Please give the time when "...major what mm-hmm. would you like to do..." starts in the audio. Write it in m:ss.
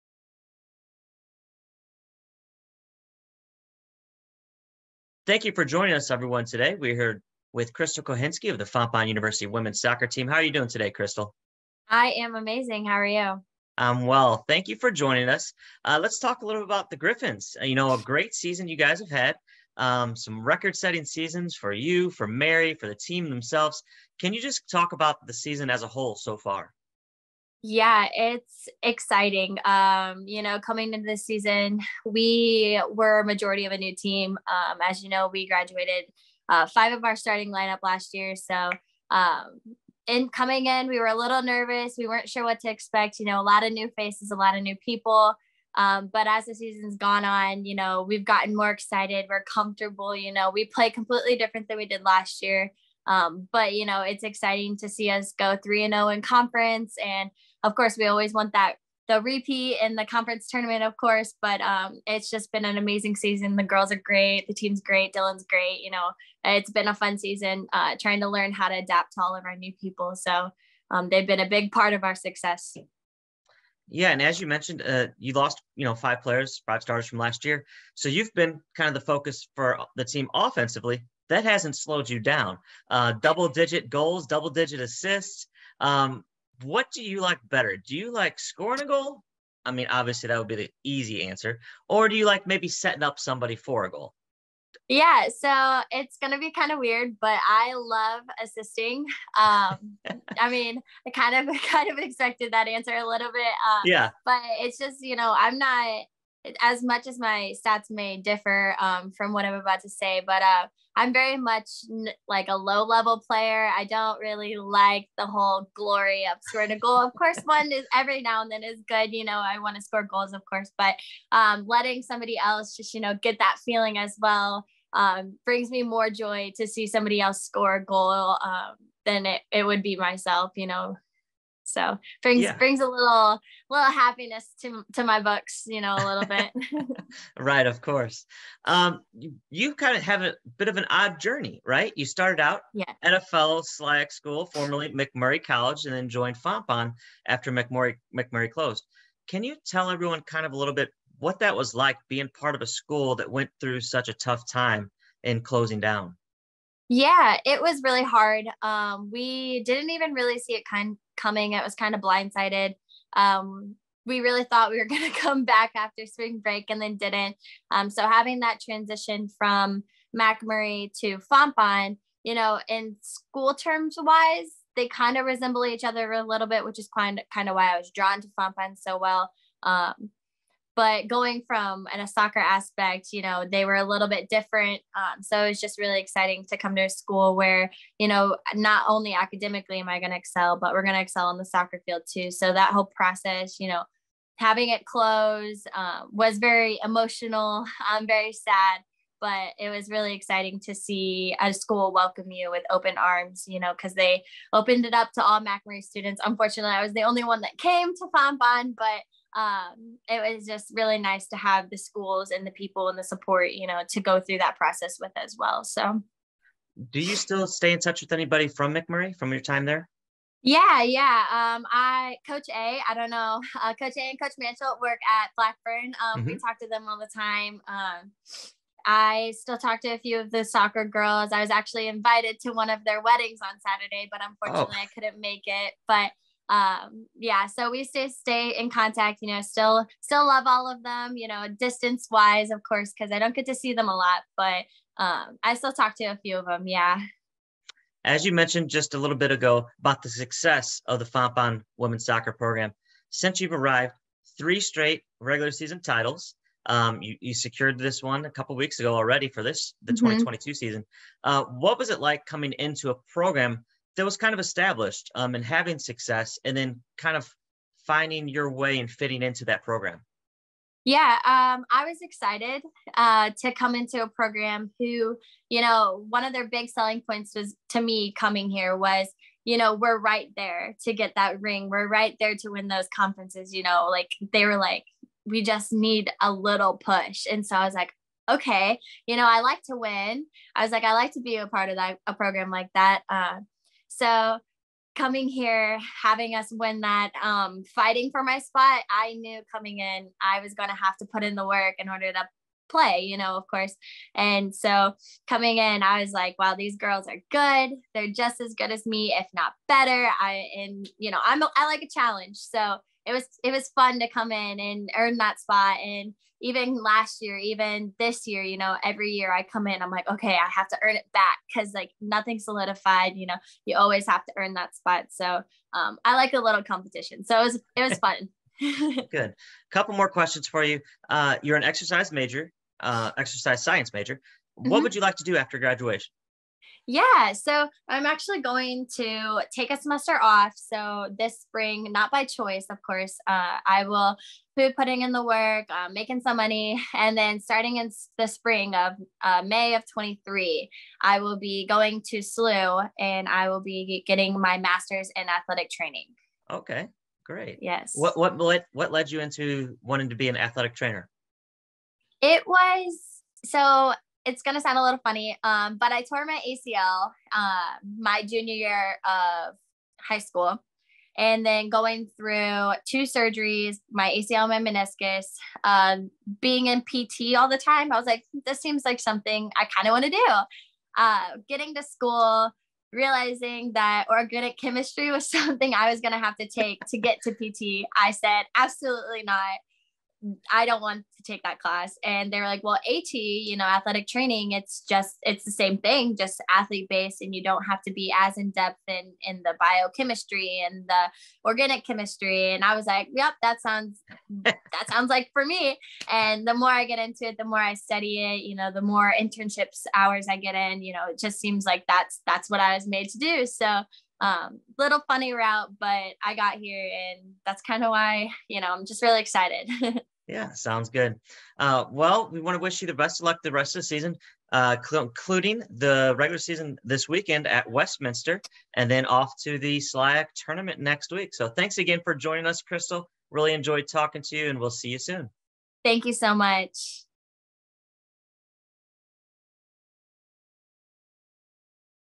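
5:33.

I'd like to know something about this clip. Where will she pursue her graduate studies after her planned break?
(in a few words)
SLU.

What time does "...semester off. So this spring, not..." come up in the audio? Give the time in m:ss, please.
5:39.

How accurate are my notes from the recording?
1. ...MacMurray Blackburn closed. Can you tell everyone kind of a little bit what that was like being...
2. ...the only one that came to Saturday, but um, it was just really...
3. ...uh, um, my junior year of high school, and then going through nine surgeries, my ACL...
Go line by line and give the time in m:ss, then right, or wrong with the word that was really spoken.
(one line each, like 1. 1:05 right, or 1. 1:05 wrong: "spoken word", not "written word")
1. 2:27 wrong: "MacMurray", not "Blackburn"
2. 3:26 wrong: "Fontbonne", not "Saturday"
3. 6:07 wrong: "two", not "nine".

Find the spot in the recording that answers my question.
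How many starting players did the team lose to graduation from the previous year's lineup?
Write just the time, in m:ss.
0:36.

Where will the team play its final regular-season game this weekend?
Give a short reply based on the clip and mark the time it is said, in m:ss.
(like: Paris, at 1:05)
Westminster, at 7:07.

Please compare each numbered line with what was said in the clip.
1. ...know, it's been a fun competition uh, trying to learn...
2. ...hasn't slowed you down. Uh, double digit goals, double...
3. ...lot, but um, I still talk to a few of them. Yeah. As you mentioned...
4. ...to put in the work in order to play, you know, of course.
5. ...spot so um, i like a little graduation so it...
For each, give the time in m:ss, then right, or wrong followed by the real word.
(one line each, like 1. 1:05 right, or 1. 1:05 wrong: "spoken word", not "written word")
1. 1:05 wrong: "season", not "competition"
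2. 1:21 right
3. 4:03 right
4. 5:00 right
5. 5:24 wrong: "competition", not "graduation".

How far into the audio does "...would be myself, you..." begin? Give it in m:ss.
2:09.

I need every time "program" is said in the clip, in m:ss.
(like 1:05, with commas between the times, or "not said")
4:12, 4:23, 4:29, 4:34, 4:52.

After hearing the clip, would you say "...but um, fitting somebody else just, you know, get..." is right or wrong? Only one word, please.
wrong.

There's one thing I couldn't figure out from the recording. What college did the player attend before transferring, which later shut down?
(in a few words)
MacMurray College.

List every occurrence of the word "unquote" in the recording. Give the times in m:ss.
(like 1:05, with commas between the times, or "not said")
not said.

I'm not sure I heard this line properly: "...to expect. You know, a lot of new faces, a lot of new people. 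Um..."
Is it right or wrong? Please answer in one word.
right.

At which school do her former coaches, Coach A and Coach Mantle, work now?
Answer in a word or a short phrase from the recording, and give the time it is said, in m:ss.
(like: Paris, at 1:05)
Blackburn, at 3:45.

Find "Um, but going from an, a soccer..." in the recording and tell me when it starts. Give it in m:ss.
2:59.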